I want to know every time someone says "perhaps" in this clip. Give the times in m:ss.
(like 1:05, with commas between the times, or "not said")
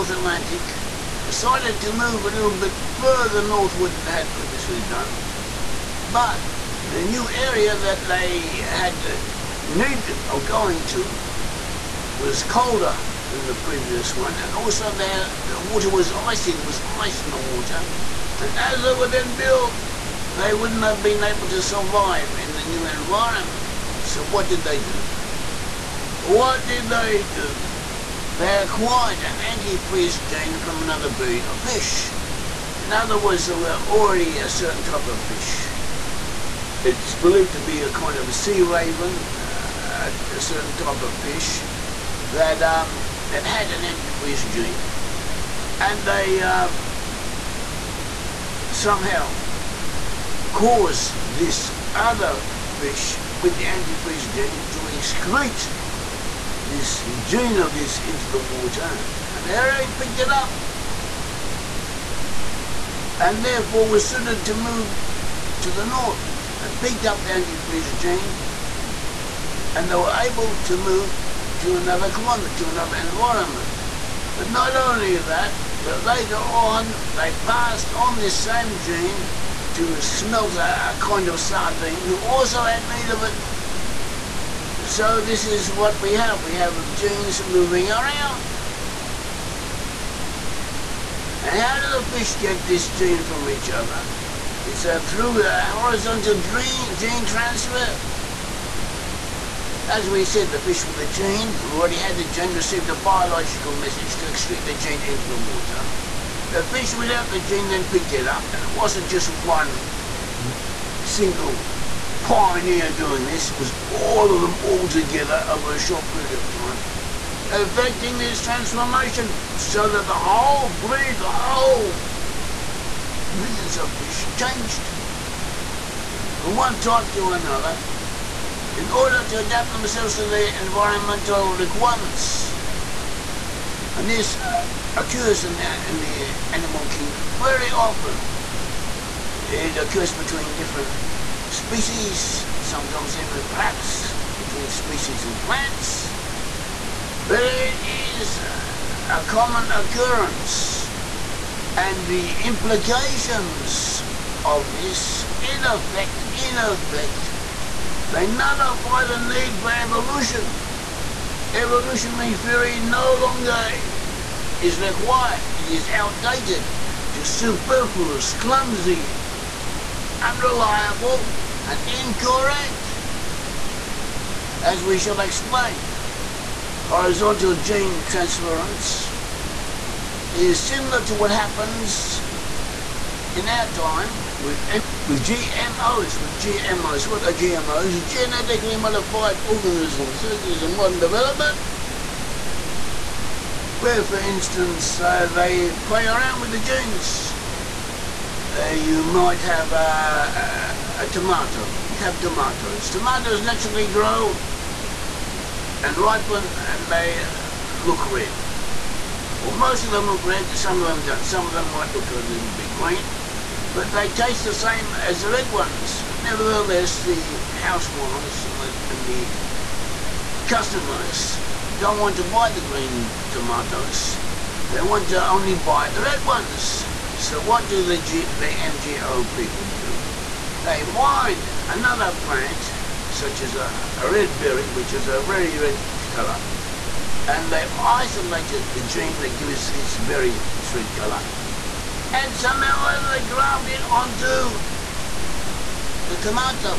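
2:23.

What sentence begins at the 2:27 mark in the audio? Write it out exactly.
But it is uh, a common occurrence and the implications of this in effect, in effect, they nullify the need for evolution.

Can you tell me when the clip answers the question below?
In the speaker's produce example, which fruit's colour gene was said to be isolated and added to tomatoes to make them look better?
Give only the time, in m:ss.
3:54.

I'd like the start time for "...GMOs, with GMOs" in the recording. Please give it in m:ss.
3:05.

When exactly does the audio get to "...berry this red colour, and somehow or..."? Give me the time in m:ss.
3:59.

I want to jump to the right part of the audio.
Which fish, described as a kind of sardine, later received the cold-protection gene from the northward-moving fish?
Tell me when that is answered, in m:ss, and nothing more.
1:20.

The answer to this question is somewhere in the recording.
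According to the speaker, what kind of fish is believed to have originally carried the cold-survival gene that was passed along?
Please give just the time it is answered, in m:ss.
0:38.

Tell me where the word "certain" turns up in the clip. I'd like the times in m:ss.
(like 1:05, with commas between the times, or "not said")
0:34, 0:40.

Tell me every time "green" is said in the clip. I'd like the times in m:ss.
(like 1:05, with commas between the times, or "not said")
3:32, 3:42.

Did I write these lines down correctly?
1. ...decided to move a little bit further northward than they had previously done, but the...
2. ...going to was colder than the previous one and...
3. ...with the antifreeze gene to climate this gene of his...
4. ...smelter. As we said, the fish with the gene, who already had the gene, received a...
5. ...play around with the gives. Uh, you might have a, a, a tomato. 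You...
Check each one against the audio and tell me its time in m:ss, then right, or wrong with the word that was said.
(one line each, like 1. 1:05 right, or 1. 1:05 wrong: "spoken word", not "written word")
1. 0:01 right
2. 0:10 right
3. 0:53 wrong: "excrete", not "climate"
4. 1:37 wrong: "transfer", not "smelter"
5. 3:15 wrong: "genes", not "gives".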